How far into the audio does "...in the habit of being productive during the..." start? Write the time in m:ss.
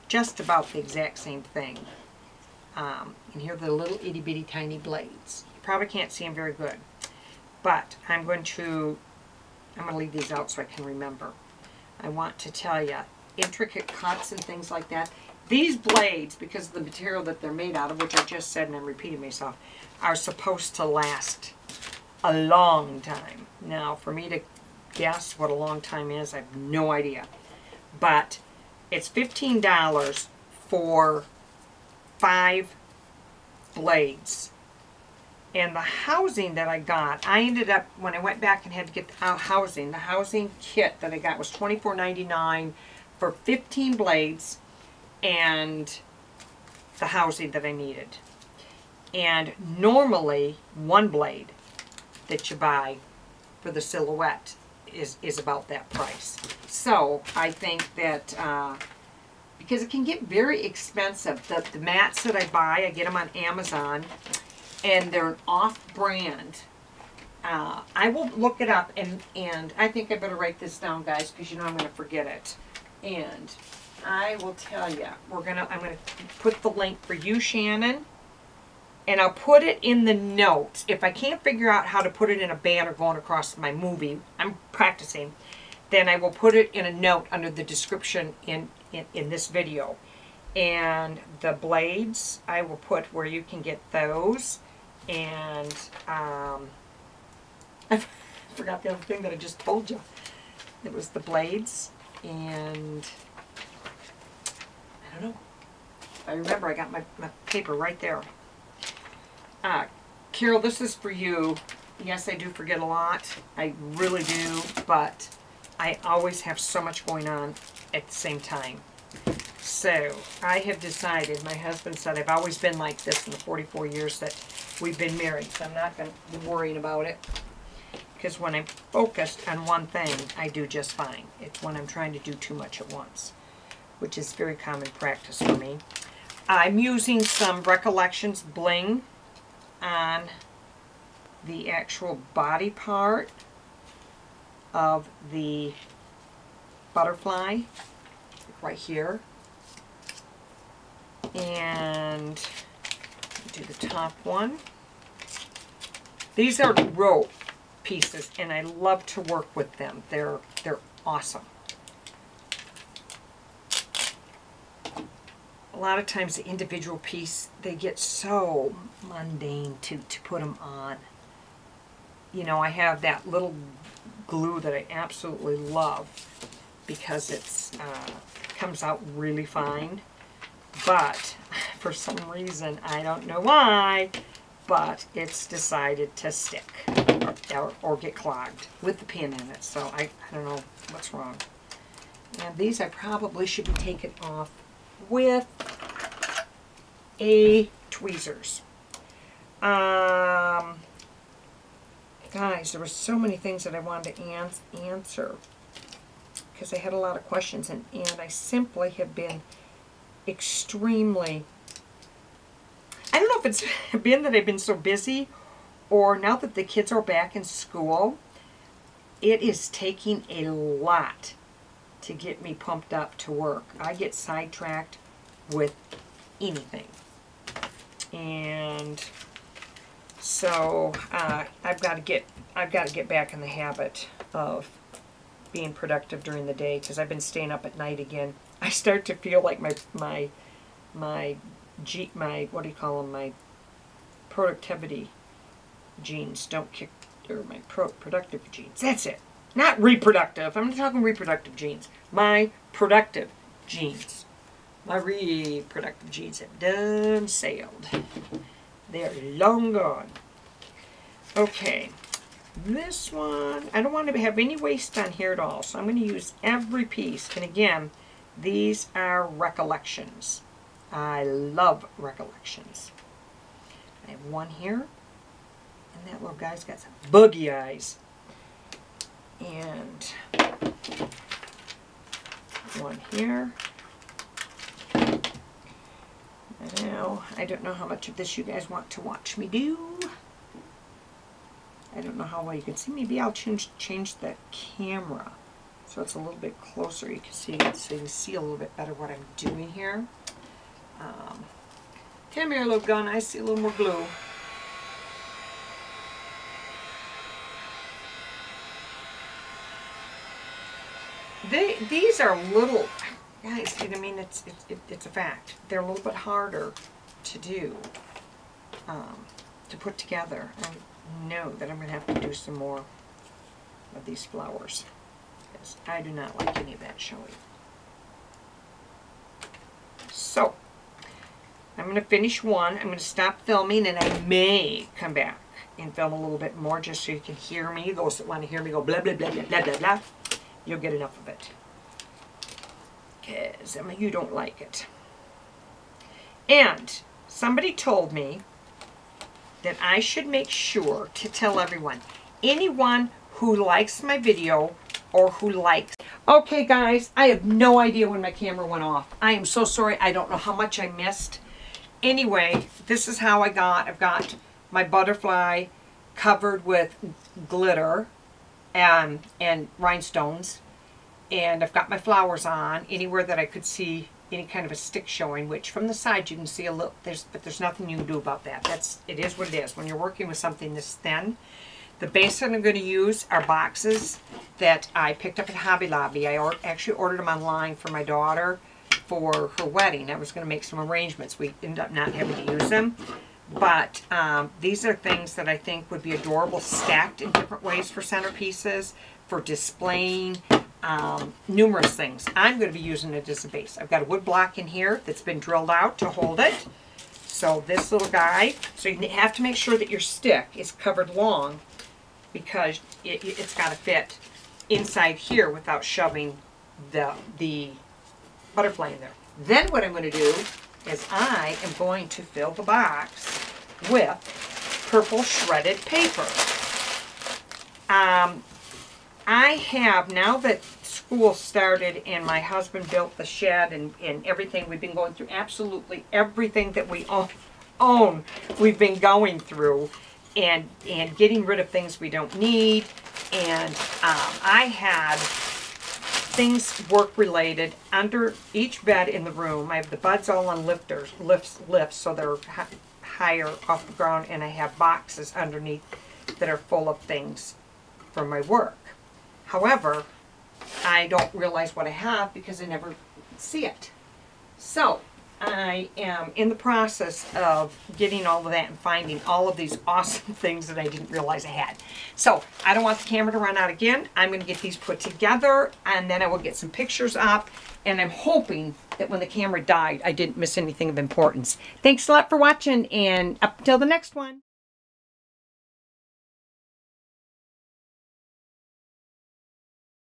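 3:53.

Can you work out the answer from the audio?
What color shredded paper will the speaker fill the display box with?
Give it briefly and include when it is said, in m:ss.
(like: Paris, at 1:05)
Purple, at 7:04.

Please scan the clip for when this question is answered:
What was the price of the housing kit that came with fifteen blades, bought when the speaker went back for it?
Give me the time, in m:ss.
0:41.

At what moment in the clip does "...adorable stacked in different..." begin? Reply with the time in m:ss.
6:36.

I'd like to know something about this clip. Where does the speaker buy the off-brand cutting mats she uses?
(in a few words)
Amazon.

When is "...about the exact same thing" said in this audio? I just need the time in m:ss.
0:00.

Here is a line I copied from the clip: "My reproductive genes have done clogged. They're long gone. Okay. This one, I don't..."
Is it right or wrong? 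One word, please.
wrong.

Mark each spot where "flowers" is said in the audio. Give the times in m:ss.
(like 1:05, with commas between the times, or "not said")
5:24, 6:11.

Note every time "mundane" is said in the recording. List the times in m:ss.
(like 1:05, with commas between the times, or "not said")
2:49.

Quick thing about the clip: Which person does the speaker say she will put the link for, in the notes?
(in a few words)
Shannon.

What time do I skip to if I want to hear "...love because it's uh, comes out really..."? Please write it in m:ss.
2:55.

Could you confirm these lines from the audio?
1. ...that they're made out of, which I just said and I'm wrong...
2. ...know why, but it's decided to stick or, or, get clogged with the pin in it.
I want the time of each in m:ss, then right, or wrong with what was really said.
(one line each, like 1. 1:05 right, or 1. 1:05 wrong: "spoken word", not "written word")
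1. 0:17 wrong: "repeating", not "wrong"
2. 3:03 right.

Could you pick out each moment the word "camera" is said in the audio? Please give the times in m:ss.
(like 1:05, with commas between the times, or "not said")
4:54, 5:58, 7:53, 7:59.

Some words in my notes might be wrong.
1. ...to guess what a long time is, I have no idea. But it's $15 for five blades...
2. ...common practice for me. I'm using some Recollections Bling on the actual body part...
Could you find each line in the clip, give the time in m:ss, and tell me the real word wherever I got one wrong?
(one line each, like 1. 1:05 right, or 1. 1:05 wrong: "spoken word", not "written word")
1. 0:24 right
2. 2:14 right.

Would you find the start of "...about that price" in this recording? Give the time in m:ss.
0:55.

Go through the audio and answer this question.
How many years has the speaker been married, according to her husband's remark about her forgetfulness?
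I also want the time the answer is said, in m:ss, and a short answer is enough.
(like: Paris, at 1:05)
44, at 2:03.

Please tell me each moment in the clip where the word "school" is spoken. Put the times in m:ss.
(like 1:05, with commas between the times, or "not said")
3:37, 7:10.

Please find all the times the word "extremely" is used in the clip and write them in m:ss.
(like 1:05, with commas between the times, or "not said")
3:30.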